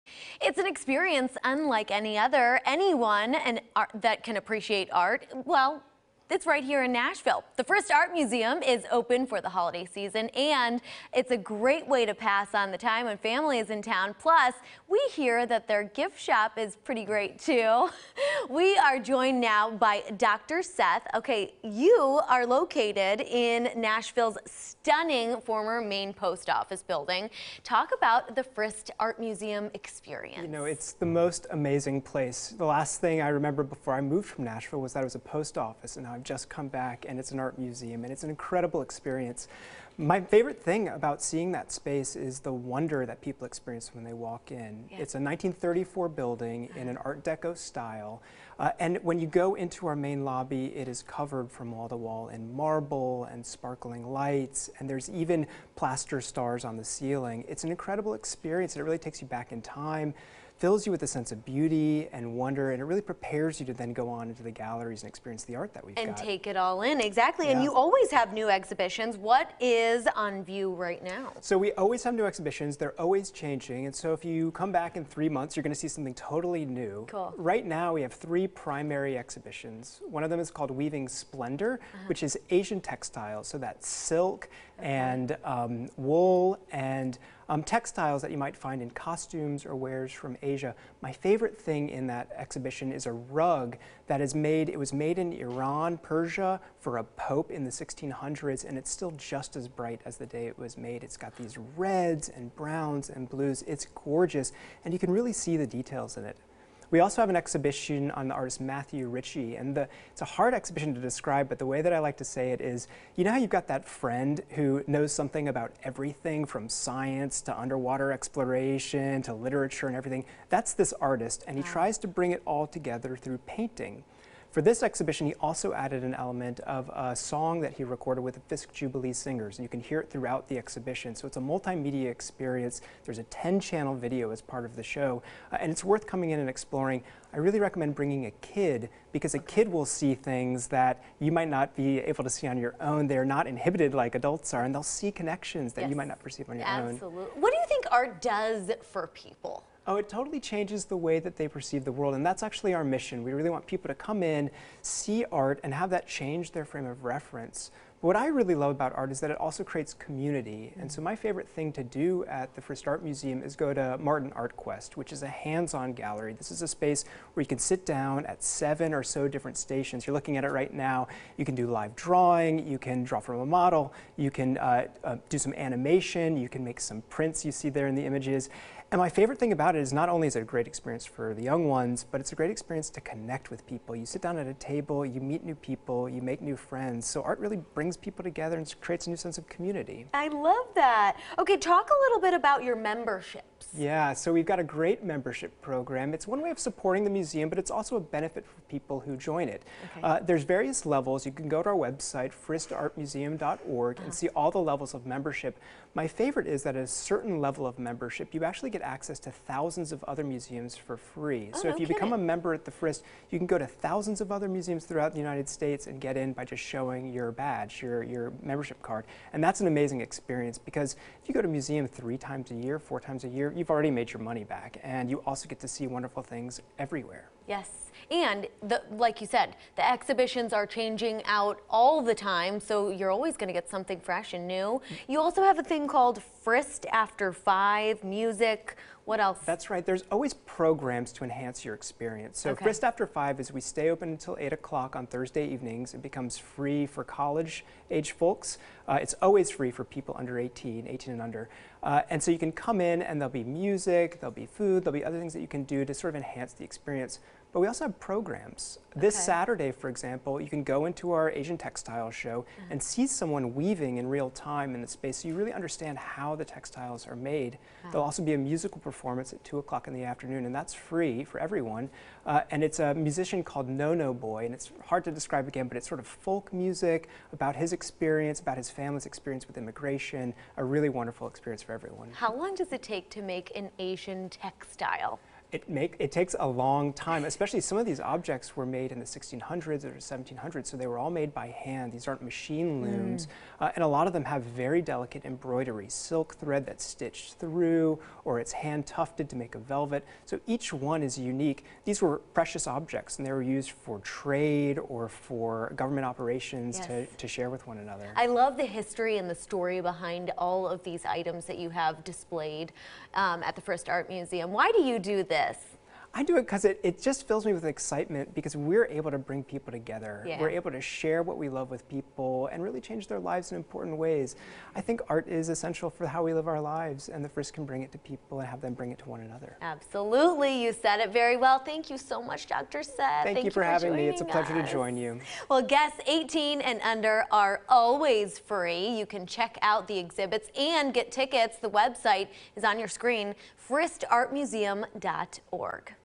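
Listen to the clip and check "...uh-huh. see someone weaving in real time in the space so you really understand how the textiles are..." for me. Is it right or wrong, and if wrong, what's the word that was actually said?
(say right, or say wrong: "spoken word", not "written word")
right.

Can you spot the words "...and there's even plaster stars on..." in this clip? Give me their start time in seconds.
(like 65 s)
54 s.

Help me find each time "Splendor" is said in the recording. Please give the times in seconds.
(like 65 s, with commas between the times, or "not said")
81 s.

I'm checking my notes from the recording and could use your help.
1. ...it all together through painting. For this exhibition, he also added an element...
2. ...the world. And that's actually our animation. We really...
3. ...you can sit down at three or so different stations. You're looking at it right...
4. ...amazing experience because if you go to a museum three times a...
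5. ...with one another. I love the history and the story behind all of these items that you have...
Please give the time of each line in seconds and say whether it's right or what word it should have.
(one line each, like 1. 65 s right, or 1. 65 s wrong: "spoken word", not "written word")
1. 122 s right
2. 151 s wrong: "mission", not "animation"
3. 167 s wrong: "seven", not "three"
4. 219 s right
5. 307 s right.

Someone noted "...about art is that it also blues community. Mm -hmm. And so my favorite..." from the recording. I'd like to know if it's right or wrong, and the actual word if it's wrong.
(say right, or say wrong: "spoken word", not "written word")
wrong: "creates", not "blues".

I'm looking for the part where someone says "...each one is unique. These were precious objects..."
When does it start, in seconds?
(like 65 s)
300 s.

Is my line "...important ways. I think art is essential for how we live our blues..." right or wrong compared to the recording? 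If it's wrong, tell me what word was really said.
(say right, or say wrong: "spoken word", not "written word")
wrong: "lives", not "blues".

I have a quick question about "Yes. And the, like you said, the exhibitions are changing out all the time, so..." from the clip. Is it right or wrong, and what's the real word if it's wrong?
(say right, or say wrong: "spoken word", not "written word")
right.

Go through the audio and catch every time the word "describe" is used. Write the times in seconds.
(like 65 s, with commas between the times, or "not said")
110 s, 275 s.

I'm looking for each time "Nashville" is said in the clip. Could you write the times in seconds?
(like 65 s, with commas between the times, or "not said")
6 s, 23 s, 34 s.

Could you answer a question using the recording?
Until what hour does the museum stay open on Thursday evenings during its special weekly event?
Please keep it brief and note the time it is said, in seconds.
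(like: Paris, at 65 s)
8 o'clock, at 244 s.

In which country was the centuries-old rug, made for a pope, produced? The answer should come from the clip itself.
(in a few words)
Iran.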